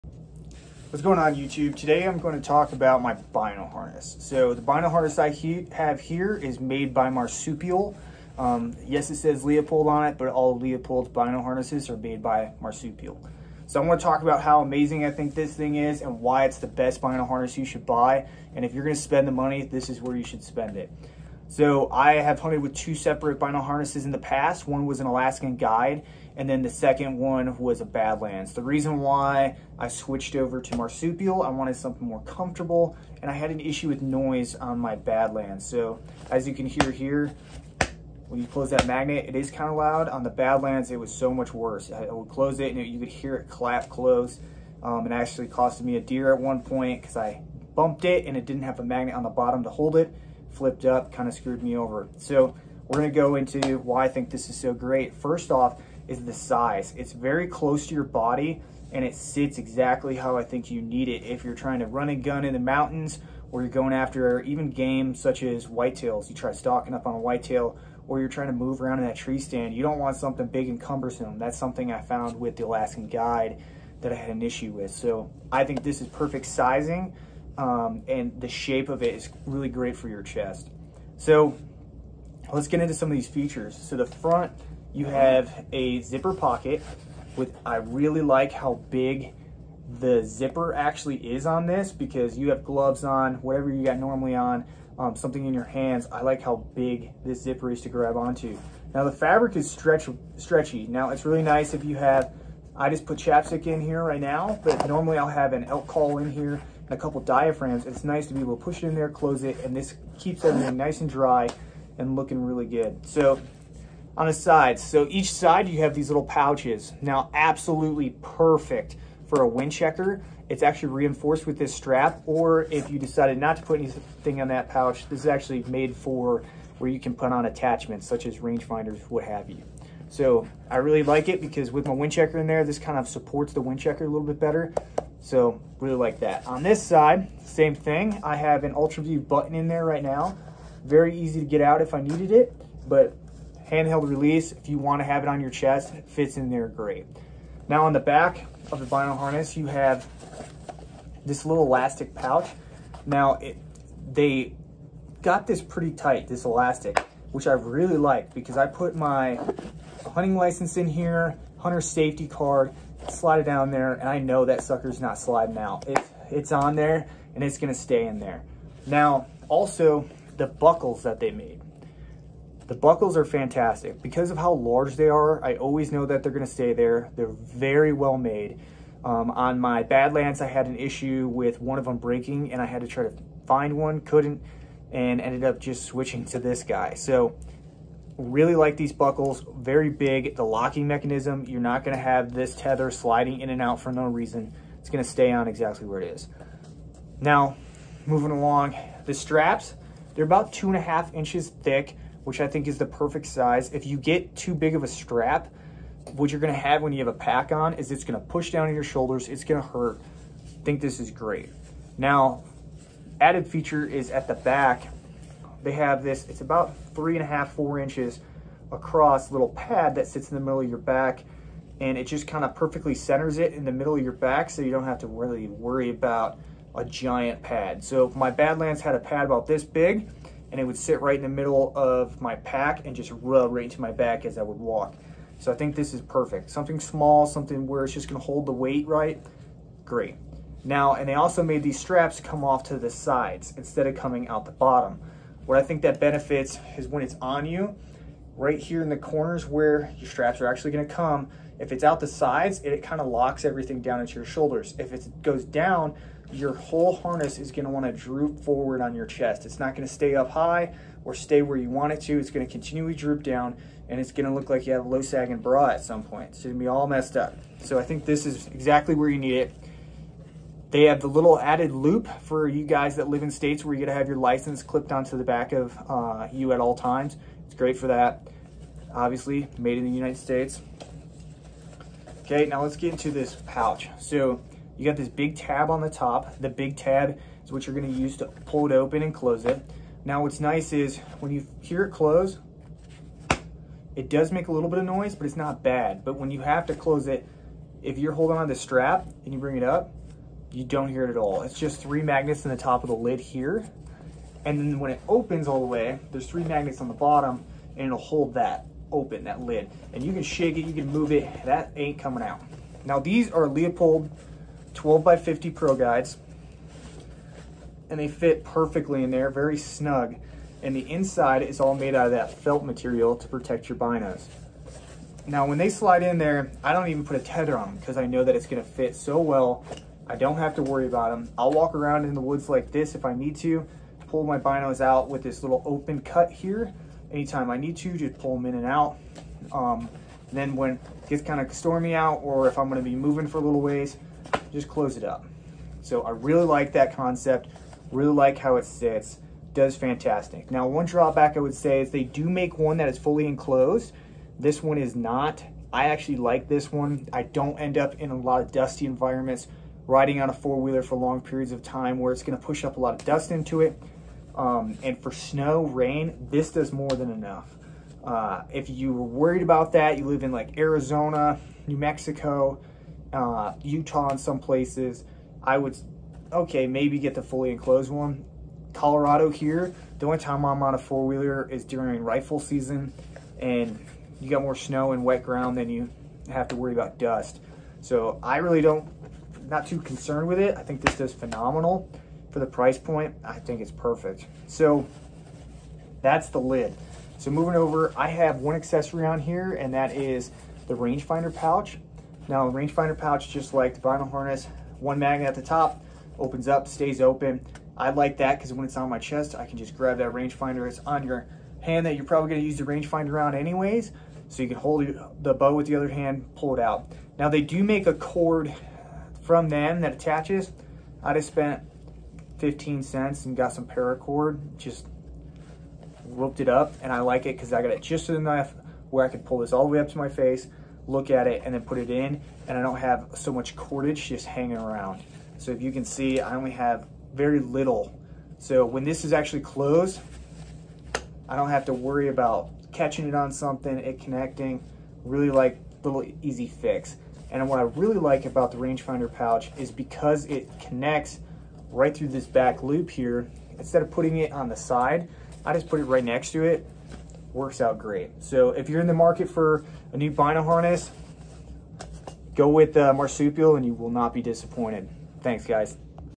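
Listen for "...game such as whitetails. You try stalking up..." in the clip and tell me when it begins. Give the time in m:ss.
1:04.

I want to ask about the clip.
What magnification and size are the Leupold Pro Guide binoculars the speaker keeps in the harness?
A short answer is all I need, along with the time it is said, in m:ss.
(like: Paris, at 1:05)
12x50, at 5:14.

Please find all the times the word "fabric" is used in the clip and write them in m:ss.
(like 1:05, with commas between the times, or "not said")
1:39.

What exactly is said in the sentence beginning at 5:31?
I'll walk around in the woods like this if I need to, pull my binos out with this little open cut here.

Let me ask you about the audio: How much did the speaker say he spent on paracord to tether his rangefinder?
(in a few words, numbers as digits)
15 cents.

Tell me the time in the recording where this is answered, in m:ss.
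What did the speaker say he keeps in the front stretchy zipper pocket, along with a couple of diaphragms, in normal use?
1:45.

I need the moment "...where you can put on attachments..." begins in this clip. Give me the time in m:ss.
2:06.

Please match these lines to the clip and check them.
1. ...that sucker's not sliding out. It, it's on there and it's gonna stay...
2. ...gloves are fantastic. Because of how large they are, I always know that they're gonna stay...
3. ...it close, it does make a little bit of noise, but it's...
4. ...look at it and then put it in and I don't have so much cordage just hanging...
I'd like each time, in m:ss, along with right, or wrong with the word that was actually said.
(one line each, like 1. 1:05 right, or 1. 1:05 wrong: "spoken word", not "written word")
1. 2:44 right
2. 2:52 wrong: "buckles", not "gloves"
3. 4:51 right
4. 7:10 right.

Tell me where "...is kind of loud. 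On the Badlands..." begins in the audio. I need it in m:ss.
0:39.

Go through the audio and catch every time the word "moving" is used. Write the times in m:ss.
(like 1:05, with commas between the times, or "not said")
3:18, 5:42, 6:37.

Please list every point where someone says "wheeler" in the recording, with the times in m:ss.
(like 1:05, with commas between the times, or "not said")
6:00, 6:20.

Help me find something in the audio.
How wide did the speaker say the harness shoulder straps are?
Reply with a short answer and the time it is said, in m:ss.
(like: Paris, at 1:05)
2.5 inches, at 3:20.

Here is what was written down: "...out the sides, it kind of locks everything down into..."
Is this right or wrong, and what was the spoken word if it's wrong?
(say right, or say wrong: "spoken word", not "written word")
right.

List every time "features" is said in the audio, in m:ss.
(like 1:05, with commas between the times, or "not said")
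1:23, 3:33.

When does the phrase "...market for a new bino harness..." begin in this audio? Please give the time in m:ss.
7:38.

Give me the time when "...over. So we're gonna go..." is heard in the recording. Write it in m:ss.
0:51.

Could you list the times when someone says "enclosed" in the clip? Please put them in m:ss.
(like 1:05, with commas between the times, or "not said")
5:53, 6:17.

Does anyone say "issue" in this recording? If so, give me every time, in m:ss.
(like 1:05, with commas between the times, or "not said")
0:33, 1:14, 3:00.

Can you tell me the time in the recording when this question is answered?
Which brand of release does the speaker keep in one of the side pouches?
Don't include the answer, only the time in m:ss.
2:18.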